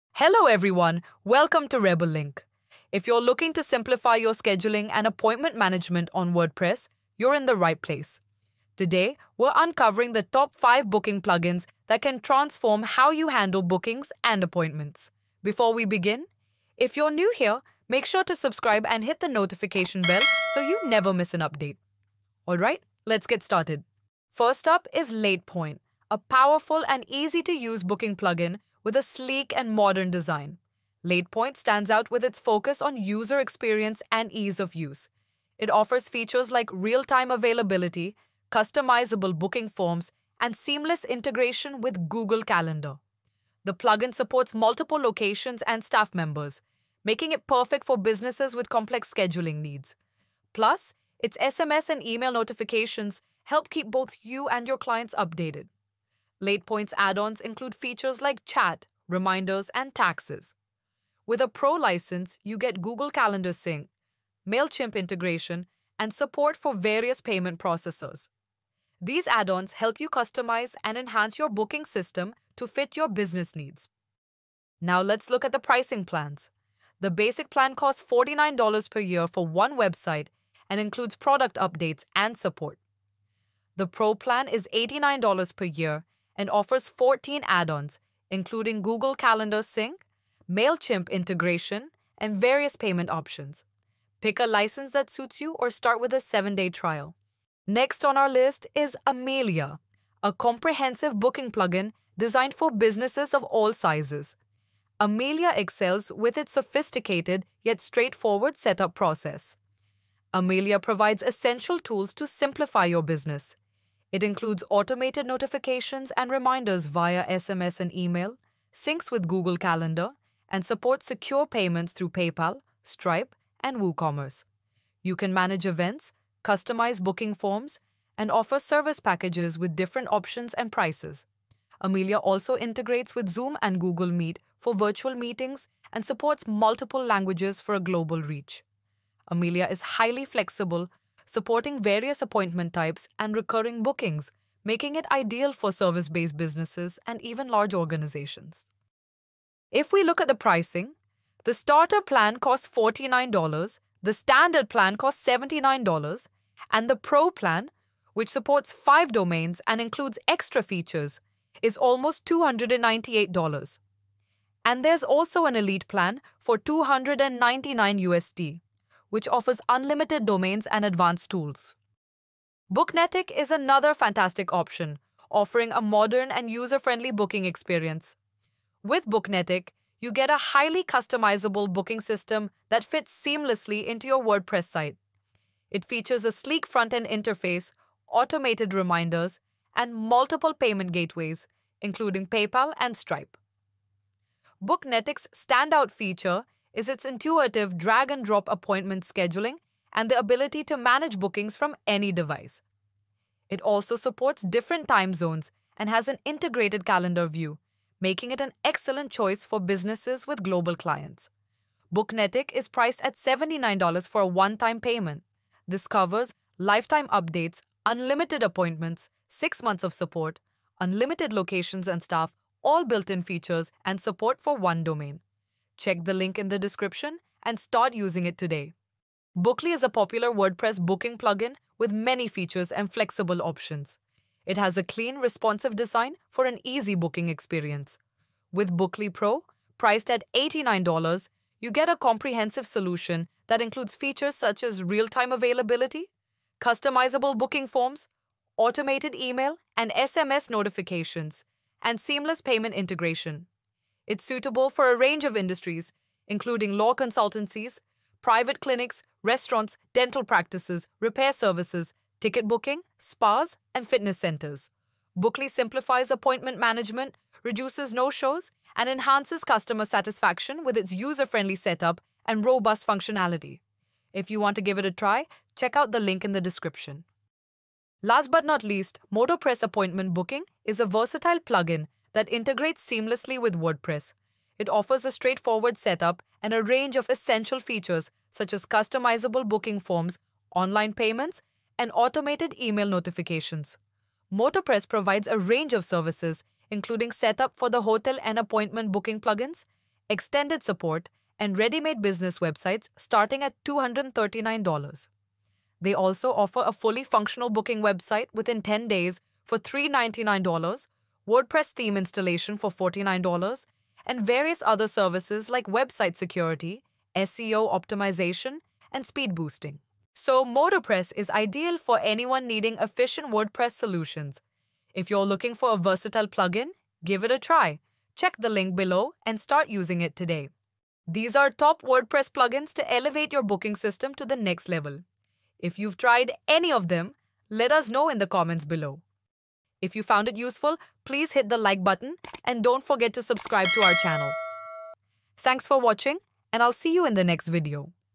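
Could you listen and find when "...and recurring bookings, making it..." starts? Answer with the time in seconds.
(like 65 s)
143 s.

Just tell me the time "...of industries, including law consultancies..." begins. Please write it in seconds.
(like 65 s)
255 s.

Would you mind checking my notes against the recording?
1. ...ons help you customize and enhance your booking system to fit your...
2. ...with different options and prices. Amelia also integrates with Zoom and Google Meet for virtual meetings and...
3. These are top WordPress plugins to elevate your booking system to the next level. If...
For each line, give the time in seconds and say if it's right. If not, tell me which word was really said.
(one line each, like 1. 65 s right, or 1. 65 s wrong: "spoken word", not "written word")
1. 69 s right
2. 129 s right
3. 331 s right.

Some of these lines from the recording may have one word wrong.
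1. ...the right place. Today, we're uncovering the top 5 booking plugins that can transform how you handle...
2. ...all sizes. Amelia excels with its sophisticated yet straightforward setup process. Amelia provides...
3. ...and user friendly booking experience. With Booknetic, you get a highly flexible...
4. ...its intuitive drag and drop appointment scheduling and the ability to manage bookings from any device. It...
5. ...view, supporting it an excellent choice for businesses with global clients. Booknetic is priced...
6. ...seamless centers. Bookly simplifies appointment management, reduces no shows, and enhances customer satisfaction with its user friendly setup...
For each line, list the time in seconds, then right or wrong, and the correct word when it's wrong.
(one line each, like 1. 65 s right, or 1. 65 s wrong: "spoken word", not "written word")
1. 7 s right
2. 103 s right
3. 176 s wrong: "customizable", not "flexible"
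4. 196 s right
5. 207 s wrong: "making", not "supporting"
6. 263 s wrong: "fitness", not "seamless".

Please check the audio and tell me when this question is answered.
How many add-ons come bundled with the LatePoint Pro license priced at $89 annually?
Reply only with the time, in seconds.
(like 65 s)
86 s.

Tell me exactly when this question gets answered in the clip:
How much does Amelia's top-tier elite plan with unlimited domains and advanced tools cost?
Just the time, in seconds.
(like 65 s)
166 s.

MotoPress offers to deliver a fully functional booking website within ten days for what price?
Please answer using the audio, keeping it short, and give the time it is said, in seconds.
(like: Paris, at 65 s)
$399, at 309 s.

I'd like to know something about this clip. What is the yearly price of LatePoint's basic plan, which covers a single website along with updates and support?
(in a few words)
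$49 per year.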